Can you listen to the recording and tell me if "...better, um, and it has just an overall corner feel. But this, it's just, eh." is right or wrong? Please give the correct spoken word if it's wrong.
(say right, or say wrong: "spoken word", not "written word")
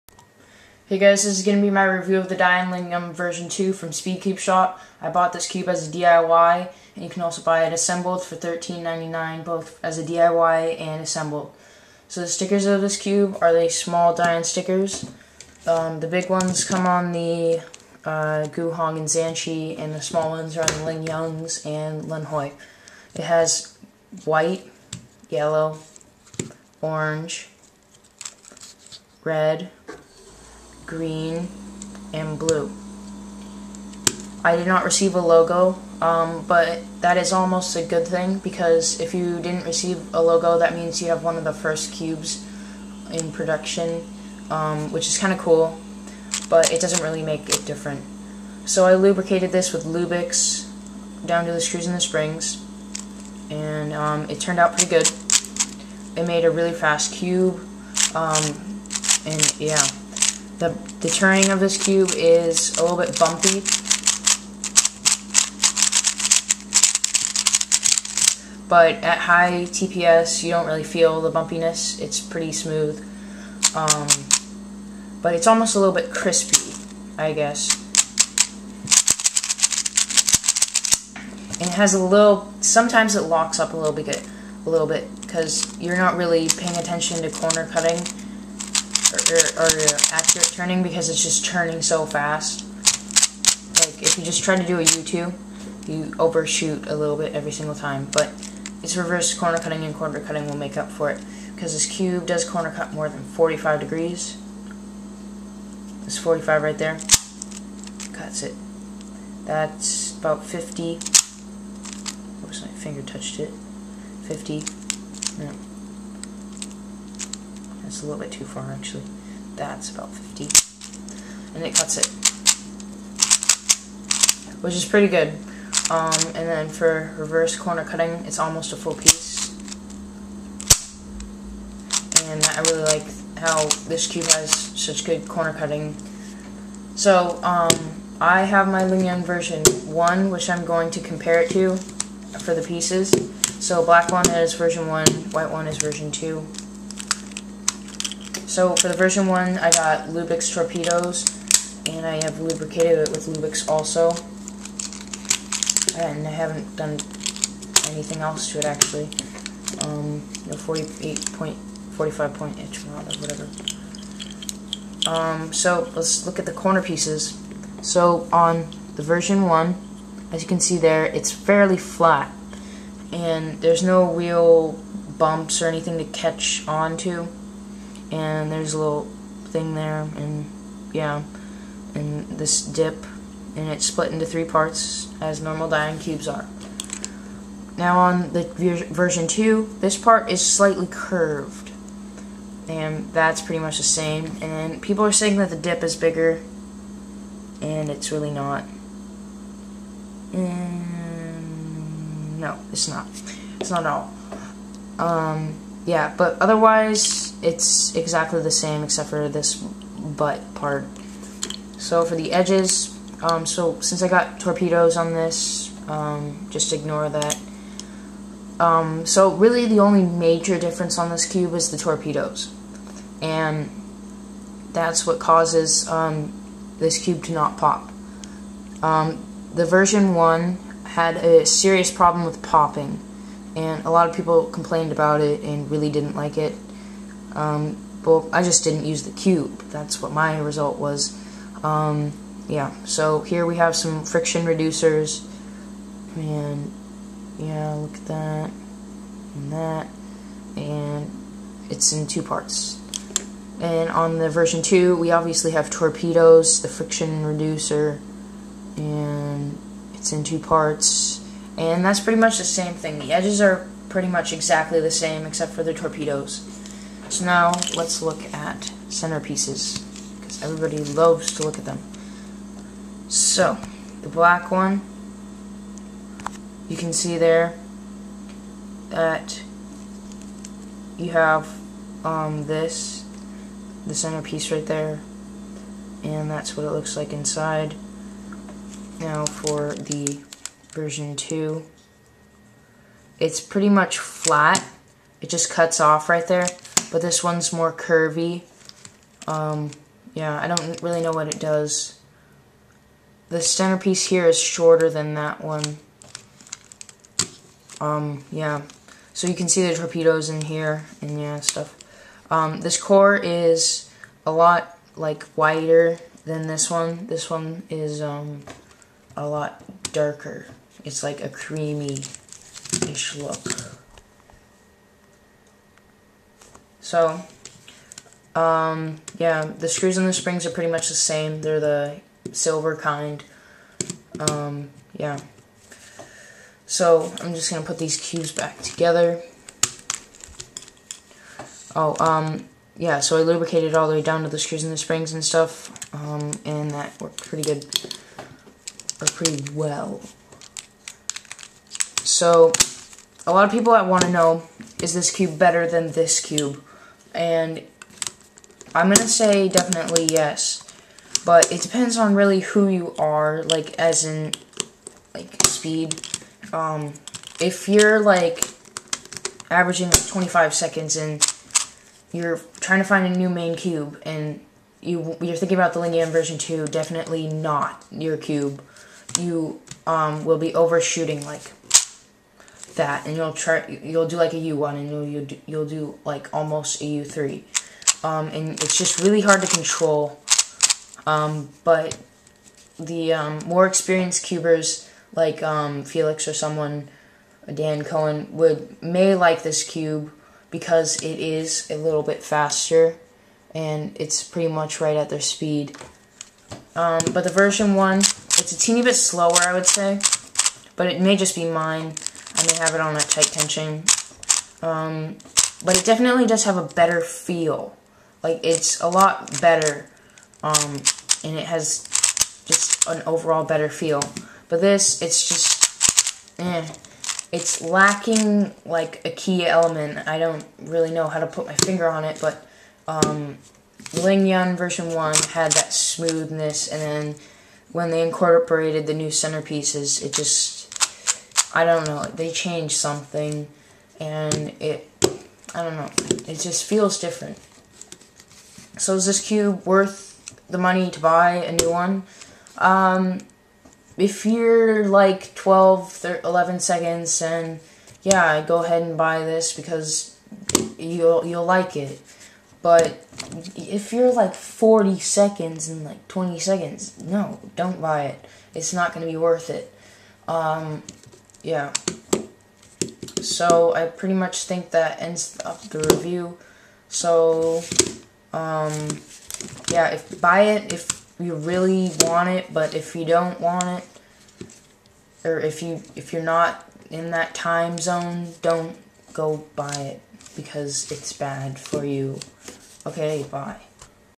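wrong: "better", not "corner".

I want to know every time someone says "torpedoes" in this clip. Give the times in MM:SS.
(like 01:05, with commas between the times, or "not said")
02:30, 03:34, 03:41, 04:15, 04:25, 05:09.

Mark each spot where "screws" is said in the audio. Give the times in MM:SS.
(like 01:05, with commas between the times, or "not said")
00:51, 05:29, 05:44.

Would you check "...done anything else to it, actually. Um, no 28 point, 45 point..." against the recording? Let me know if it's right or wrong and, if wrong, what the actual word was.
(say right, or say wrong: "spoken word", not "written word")
wrong: "48", not "28".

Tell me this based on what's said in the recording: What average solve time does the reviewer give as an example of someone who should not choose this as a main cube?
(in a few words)
25 seconds.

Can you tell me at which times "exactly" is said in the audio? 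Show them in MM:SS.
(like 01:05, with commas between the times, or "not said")
03:27, 04:24.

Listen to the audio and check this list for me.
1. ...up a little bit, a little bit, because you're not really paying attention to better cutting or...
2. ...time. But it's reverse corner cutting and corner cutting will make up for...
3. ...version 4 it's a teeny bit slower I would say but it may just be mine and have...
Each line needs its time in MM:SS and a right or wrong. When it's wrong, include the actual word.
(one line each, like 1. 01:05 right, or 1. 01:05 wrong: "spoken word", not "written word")
1. 01:23 wrong: "corner", not "better"
2. 01:37 right
3. 06:47 wrong: "1", not "4".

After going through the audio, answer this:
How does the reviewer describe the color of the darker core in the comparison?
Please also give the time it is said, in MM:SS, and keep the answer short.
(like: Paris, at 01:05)
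Creamy-ish, at 05:21.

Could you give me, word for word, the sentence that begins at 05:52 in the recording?
So a lot of people that want to know, is this cube better than this cube?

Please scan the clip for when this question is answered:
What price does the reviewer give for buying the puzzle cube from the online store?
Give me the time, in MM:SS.
00:08.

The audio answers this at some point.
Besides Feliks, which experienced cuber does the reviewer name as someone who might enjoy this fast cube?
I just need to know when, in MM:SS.
06:37.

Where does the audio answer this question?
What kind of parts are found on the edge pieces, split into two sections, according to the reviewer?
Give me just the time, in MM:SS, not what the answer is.
04:04.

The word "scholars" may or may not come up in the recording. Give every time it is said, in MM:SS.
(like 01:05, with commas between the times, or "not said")
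not said.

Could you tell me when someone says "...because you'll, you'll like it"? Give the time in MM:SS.
07:39.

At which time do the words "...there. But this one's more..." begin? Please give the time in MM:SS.
04:56.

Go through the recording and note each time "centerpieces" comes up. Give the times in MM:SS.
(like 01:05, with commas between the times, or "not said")
04:28, 04:43, 05:03, 07:19.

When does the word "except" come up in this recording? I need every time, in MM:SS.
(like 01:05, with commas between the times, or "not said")
03:28, 04:25.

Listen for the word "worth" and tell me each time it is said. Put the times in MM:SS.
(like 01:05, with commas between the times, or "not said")
07:29, 07:49.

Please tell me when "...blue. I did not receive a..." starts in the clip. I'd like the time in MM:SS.
00:32.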